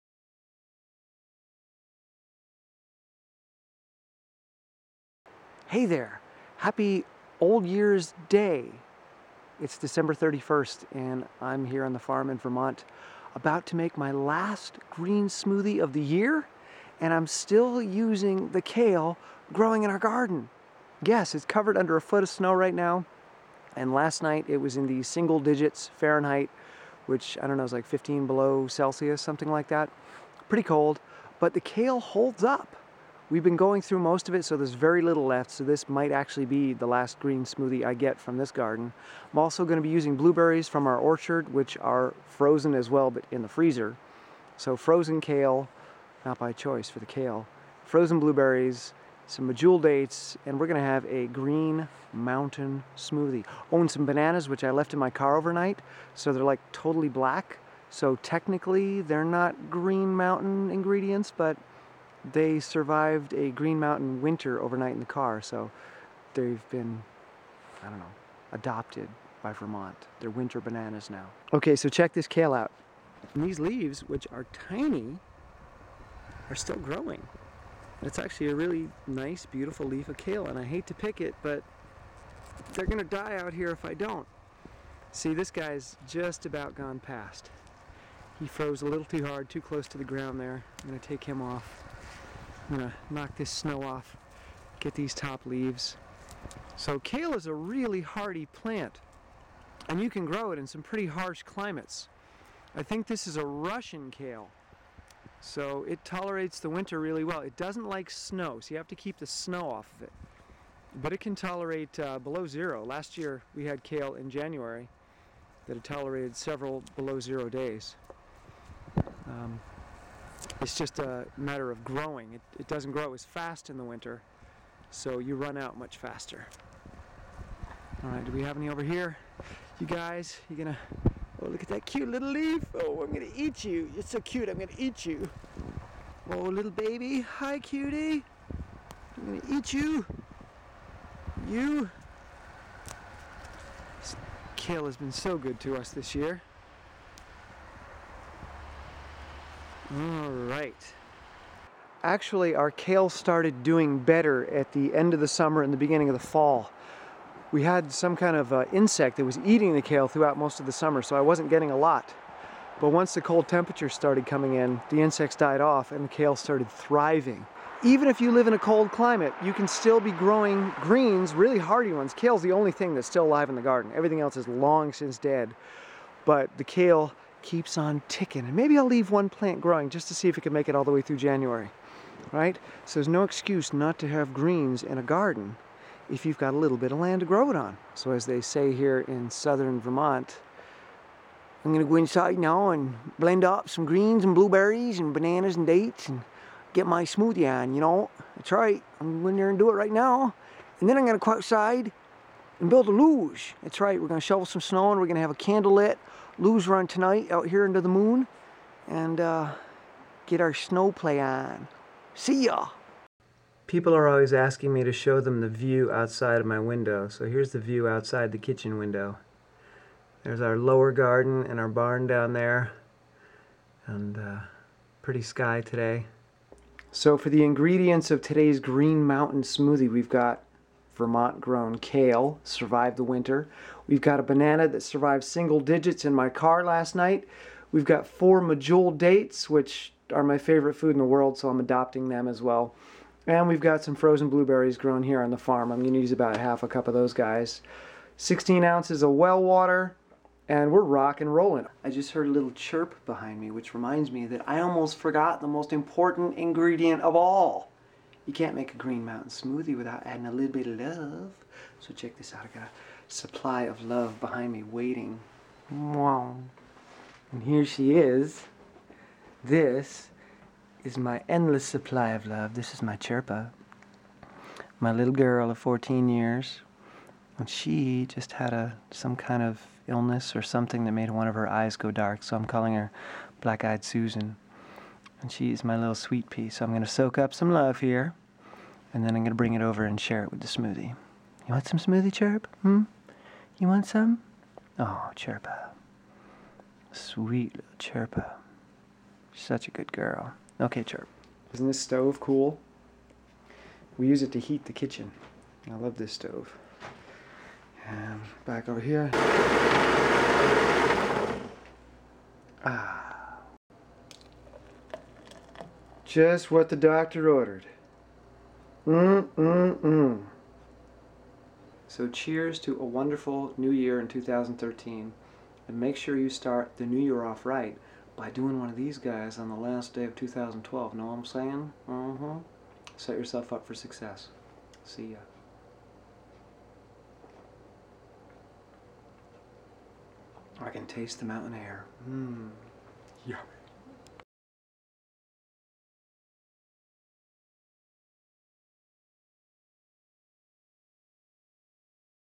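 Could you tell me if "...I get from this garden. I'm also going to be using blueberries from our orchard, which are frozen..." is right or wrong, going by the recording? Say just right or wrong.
right.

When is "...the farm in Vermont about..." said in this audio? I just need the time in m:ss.
0:11.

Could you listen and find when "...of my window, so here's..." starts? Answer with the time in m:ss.
3:36.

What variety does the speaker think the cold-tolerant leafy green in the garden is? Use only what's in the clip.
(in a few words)
Russian kale.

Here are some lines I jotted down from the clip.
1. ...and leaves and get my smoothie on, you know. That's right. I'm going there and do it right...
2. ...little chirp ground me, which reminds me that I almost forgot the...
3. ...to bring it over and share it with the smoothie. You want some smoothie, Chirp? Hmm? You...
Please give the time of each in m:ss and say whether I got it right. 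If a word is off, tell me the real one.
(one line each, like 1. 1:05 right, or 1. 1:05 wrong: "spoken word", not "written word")
1. 3:15 wrong: "dates", not "leaves"
2. 4:12 wrong: "behind", not "ground"
3. 4:49 right.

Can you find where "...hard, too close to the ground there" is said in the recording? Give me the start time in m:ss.
1:29.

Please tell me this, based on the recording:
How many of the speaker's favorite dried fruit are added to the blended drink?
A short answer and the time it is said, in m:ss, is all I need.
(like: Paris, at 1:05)
4, at 3:58.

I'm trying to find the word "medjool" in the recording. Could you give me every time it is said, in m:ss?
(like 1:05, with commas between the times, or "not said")
0:49, 3:58.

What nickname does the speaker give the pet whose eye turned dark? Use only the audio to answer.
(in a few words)
Black Eyed Susan.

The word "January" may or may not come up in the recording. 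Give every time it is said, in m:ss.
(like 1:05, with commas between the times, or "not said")
1:54, 3:01.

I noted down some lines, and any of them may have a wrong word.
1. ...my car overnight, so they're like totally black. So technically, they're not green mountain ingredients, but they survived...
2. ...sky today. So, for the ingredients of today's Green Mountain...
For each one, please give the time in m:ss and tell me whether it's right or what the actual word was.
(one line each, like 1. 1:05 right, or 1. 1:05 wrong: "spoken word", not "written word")
1. 0:54 right
2. 3:45 right.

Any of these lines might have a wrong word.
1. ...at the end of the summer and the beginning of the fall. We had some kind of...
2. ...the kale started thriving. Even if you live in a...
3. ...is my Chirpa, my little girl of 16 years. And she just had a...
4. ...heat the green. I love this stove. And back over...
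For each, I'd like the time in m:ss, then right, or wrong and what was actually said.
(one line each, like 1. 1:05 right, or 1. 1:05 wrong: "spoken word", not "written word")
1. 2:34 right
2. 2:46 right
3. 4:32 wrong: "14", not "16"
4. 5:04 wrong: "kitchen", not "green".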